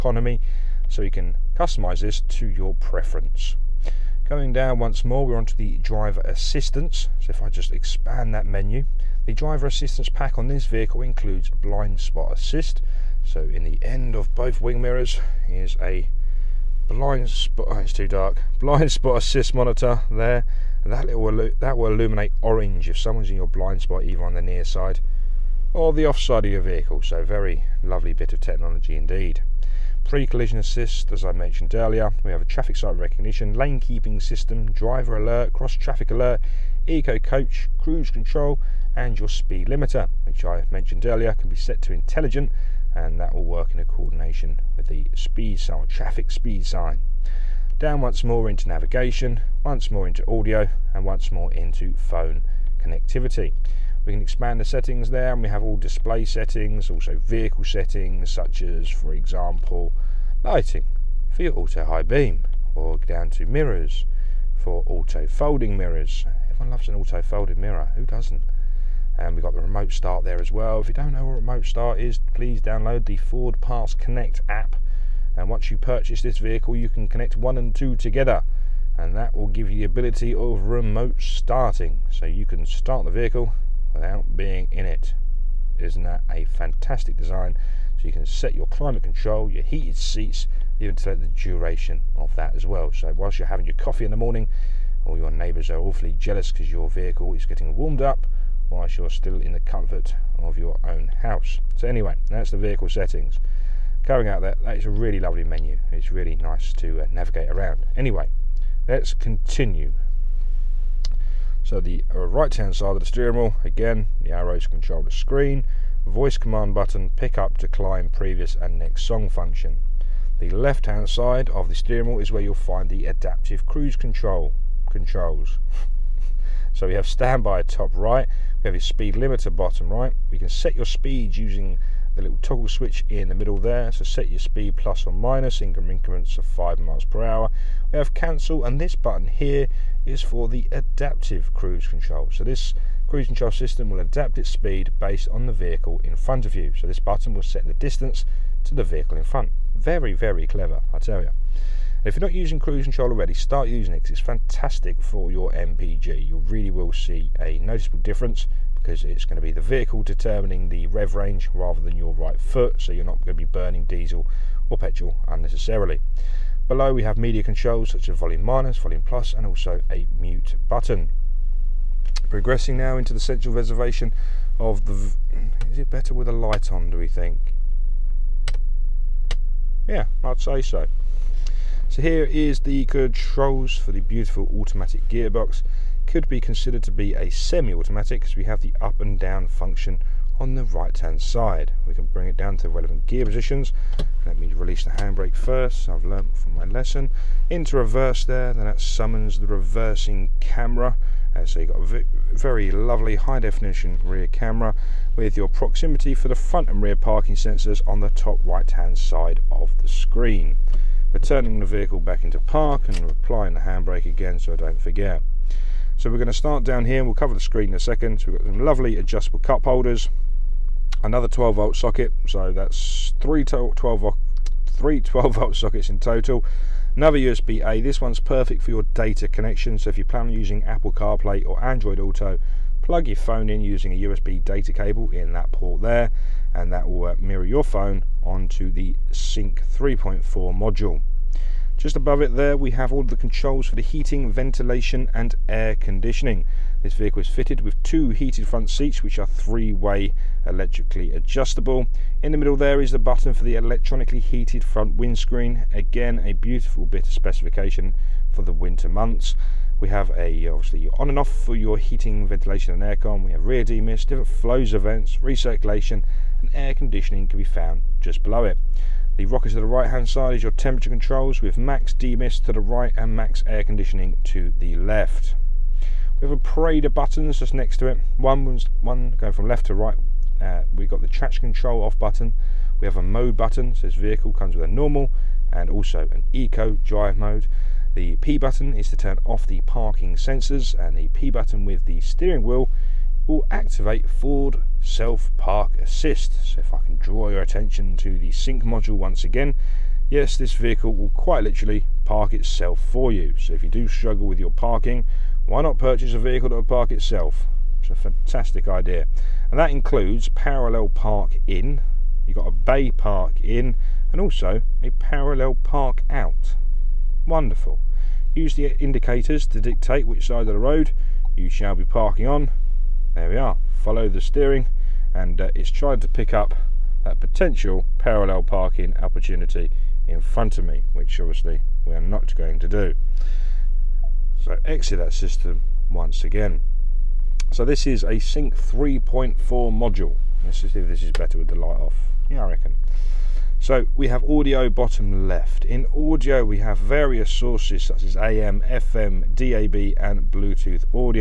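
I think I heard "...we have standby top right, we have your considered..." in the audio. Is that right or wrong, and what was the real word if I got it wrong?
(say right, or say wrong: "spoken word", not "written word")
wrong: "speed", not "considered".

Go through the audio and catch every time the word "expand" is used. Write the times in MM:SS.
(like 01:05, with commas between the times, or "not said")
00:07, 00:54.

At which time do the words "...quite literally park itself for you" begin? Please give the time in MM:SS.
05:01.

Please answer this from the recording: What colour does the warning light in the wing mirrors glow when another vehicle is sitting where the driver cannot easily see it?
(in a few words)
Orange.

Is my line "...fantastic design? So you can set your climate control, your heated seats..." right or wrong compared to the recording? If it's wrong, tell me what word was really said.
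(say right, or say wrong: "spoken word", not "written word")
right.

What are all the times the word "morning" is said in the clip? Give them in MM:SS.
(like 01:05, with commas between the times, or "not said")
01:34.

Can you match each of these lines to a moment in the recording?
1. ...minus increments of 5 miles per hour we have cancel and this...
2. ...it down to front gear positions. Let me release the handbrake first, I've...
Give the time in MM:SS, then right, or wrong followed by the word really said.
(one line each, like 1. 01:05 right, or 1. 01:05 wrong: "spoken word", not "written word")
1. 02:15 right
2. 03:12 wrong: "relevant", not "front".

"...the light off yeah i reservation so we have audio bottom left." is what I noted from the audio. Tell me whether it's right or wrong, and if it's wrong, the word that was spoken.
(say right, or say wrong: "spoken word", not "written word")
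wrong: "reckon", not "reservation".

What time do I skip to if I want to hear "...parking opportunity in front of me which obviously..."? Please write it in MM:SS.
05:28.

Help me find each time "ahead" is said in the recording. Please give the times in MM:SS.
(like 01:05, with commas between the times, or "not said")
not said.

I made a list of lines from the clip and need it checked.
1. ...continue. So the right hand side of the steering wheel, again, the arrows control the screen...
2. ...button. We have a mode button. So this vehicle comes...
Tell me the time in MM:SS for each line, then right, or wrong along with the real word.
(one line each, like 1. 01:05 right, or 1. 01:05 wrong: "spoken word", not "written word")
1. 01:49 right
2. 04:41 right.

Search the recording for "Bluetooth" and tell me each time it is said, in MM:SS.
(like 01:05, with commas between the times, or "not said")
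05:50.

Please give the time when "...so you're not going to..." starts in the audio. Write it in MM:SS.
02:42.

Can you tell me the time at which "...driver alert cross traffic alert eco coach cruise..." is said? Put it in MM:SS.
00:34.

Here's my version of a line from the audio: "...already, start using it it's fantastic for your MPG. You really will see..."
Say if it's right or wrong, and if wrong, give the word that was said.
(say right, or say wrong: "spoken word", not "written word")
right.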